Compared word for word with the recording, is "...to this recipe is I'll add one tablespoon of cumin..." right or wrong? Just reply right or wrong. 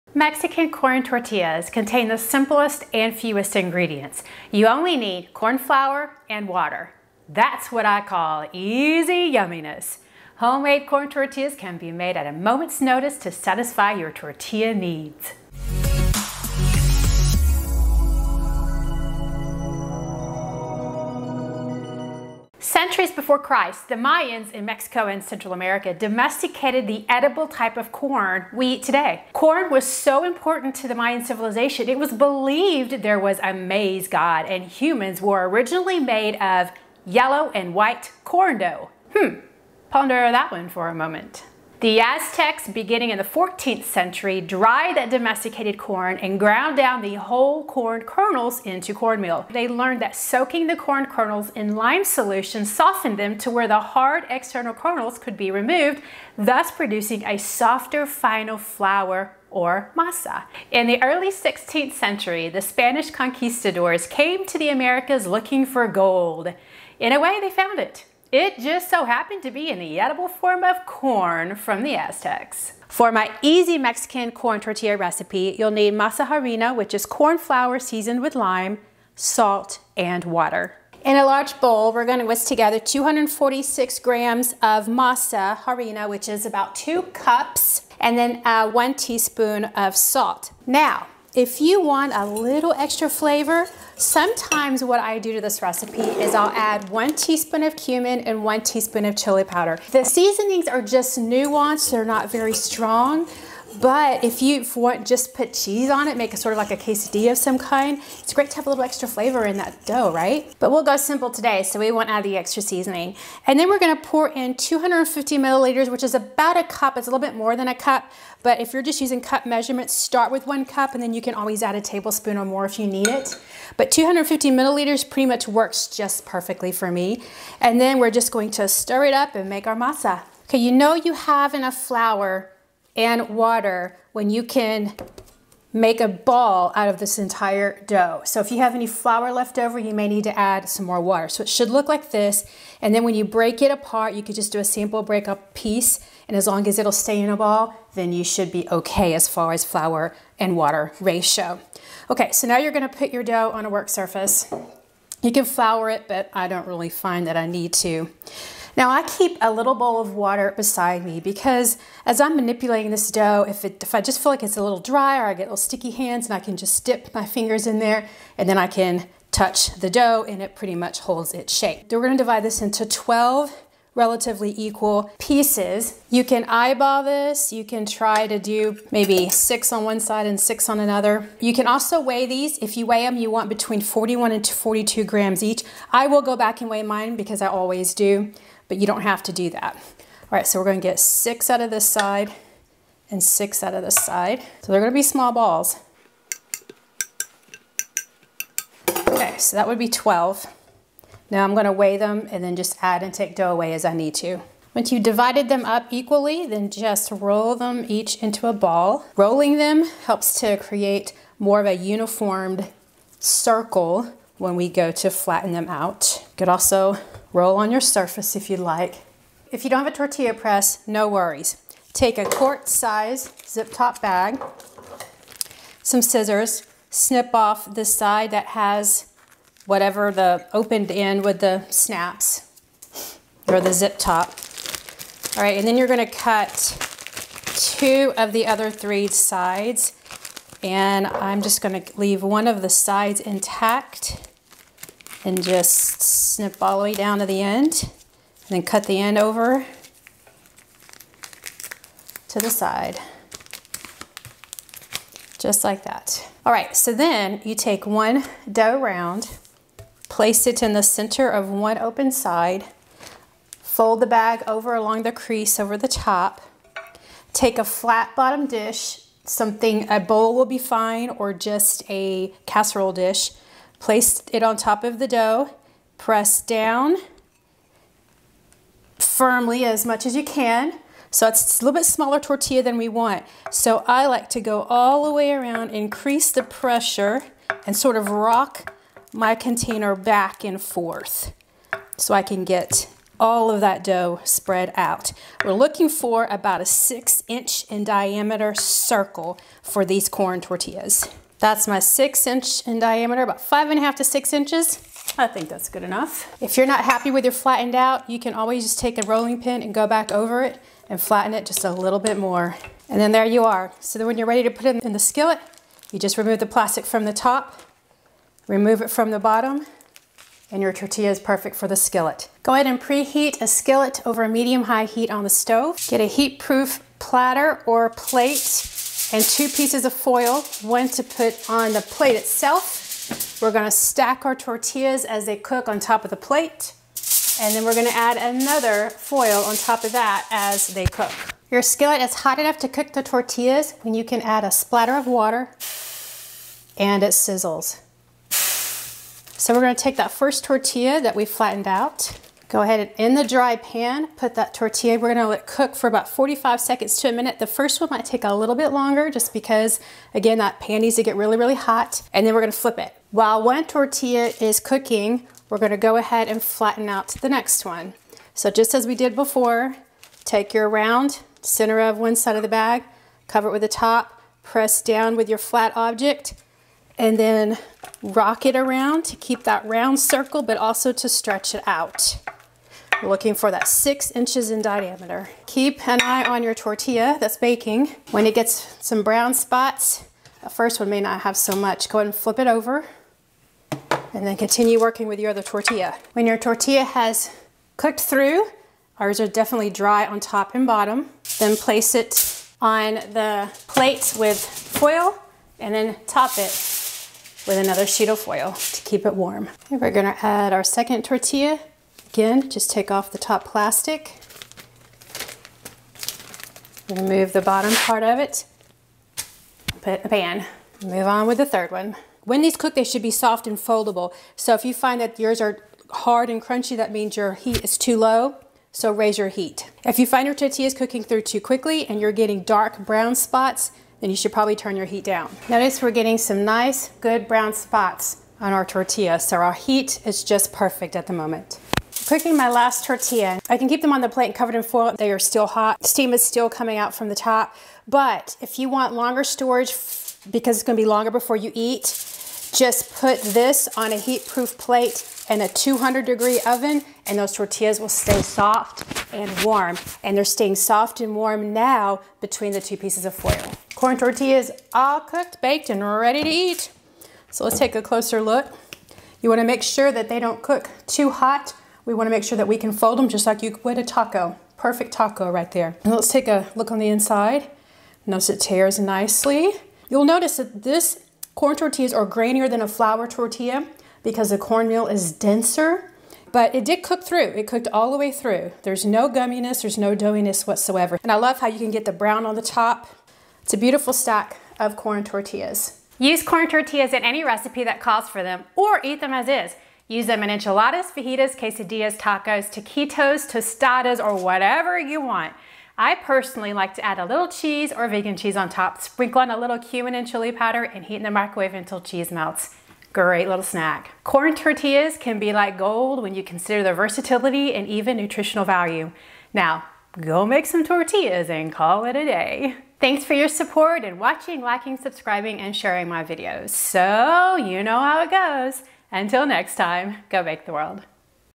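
wrong.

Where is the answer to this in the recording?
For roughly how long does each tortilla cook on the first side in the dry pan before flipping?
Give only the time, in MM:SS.
05:56.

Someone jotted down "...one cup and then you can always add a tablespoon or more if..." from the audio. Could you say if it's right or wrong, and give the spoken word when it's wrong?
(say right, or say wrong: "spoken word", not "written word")
right.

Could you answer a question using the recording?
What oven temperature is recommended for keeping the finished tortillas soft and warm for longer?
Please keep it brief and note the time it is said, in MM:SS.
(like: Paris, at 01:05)
200 degrees, at 07:35.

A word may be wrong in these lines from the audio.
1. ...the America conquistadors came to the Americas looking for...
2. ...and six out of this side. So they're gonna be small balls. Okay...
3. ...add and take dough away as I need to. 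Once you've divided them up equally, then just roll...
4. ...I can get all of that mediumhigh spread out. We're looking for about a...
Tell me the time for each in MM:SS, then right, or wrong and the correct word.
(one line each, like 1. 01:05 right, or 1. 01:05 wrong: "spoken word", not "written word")
1. 01:02 wrong: "Spanish", not "America"
2. 03:13 right
3. 03:22 right
4. 04:52 wrong: "dough", not "mediumhigh".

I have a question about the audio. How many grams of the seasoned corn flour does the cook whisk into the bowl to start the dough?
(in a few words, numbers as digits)
246 grams.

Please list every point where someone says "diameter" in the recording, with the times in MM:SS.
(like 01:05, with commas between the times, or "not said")
04:57, 05:02, 06:24.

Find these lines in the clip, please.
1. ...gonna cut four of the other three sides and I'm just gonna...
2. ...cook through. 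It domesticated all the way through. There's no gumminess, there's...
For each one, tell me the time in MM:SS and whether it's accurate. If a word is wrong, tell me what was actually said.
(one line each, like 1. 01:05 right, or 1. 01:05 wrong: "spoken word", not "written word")
1. 03:55 wrong: "two", not "four"
2. 08:06 wrong: "cooked", not "domesticated".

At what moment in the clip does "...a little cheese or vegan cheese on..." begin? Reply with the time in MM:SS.
08:26.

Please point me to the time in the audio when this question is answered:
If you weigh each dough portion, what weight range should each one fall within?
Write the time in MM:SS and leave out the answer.
03:03.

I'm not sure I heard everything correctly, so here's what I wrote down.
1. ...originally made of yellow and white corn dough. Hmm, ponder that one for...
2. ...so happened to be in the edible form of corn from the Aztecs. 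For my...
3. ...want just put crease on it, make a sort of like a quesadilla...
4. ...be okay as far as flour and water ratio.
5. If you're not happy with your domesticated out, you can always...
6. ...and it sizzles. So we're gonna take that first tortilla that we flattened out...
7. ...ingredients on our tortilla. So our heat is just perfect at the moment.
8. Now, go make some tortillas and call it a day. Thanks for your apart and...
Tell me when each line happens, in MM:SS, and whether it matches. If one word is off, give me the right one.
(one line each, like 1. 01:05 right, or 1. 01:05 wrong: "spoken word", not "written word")
1. 00:35 right
2. 01:08 right
3. 01:44 wrong: "cheese", not "crease"
4. 02:28 right
5. 05:06 wrong: "flattened", not "domesticated"
6. 05:46 right
7. 07:17 wrong: "spots", not "ingredients"
8. 08:39 wrong: "support", not "apart".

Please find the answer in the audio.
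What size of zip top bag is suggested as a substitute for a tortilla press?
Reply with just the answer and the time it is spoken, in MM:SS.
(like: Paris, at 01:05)
Quart size, at 03:42.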